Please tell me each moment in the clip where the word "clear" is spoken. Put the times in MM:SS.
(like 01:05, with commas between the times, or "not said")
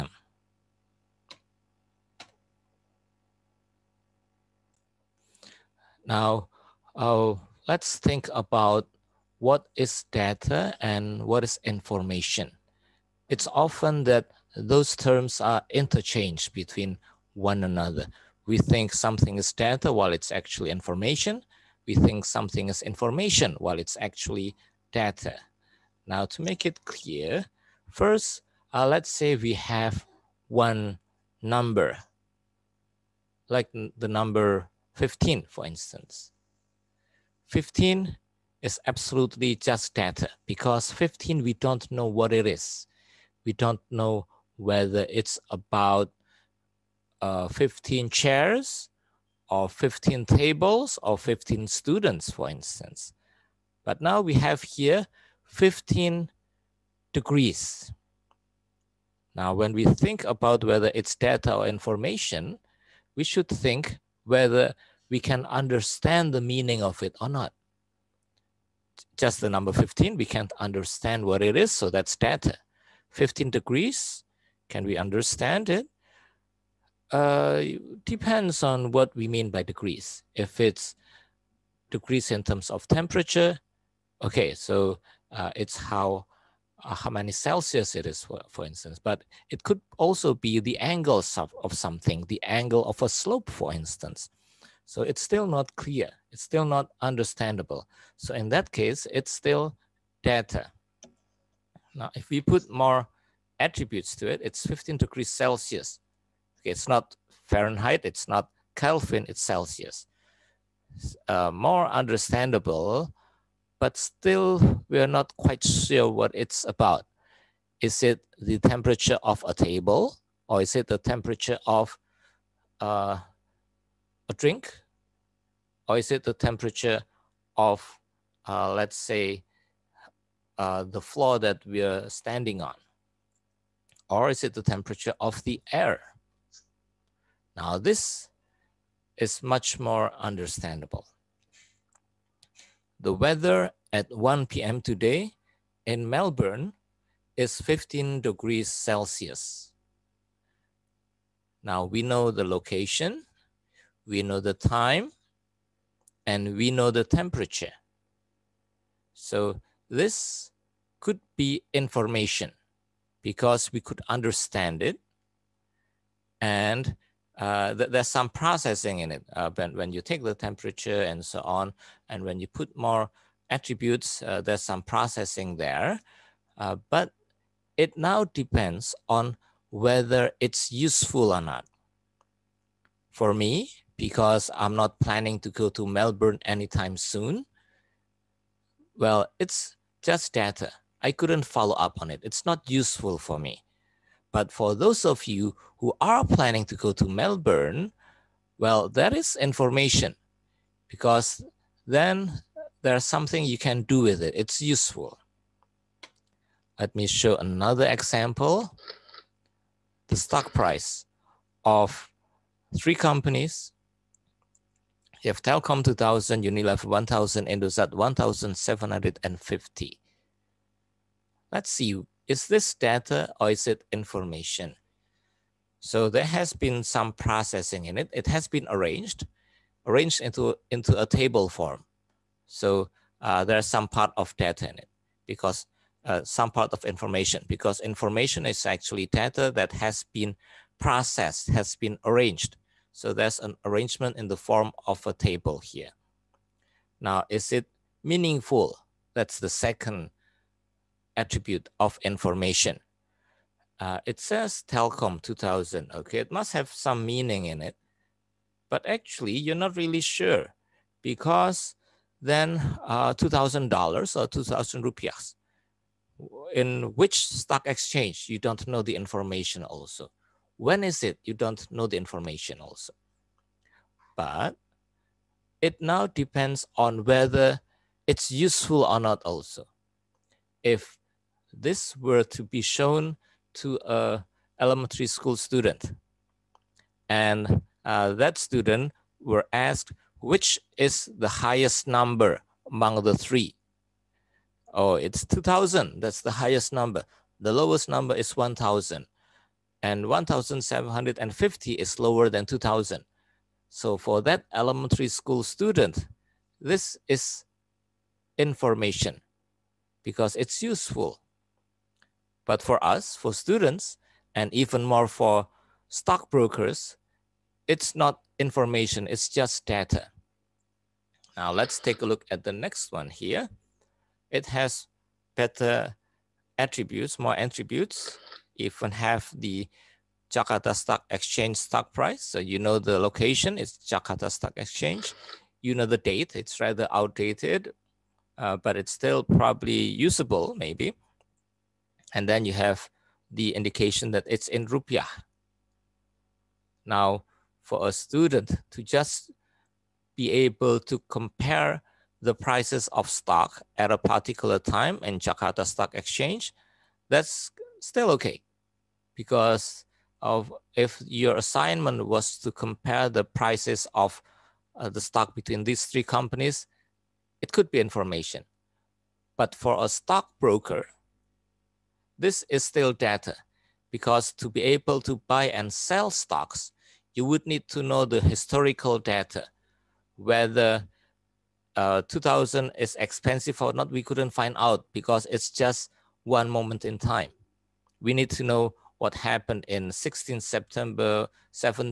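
00:26, 01:35.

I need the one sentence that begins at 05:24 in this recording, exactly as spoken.
It has better attributes, more attributes even have the Jakarta Stock Exchange stock price.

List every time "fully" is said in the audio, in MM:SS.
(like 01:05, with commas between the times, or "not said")
not said.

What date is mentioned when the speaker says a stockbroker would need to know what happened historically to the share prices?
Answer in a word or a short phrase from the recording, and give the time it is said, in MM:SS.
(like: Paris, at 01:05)
16 September, at 06:29.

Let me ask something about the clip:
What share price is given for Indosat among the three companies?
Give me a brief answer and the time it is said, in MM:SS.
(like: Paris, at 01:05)
1750, at 03:37.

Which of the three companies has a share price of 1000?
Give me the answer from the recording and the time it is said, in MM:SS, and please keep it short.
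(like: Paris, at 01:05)
Unilever, at 03:36.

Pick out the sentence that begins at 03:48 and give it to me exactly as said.
It has been arranged, arranged into, into a table form.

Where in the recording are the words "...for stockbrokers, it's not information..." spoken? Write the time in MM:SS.
05:15.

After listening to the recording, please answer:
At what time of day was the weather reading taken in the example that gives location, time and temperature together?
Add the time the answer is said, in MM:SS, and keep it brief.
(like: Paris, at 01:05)
1 p.m., at 02:24.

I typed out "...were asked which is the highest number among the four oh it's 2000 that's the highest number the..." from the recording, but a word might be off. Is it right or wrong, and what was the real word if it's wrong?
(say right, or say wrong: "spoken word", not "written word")
wrong: "three", not "four".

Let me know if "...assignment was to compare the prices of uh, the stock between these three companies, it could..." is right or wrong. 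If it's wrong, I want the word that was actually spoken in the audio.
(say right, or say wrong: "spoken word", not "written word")
right.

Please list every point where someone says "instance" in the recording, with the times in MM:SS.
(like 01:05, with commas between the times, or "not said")
00:35, 00:52, 01:28, 01:33.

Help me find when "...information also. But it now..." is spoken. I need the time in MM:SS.
04:31.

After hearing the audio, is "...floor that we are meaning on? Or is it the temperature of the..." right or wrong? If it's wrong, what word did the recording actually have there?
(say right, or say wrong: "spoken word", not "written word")
wrong: "standing", not "meaning".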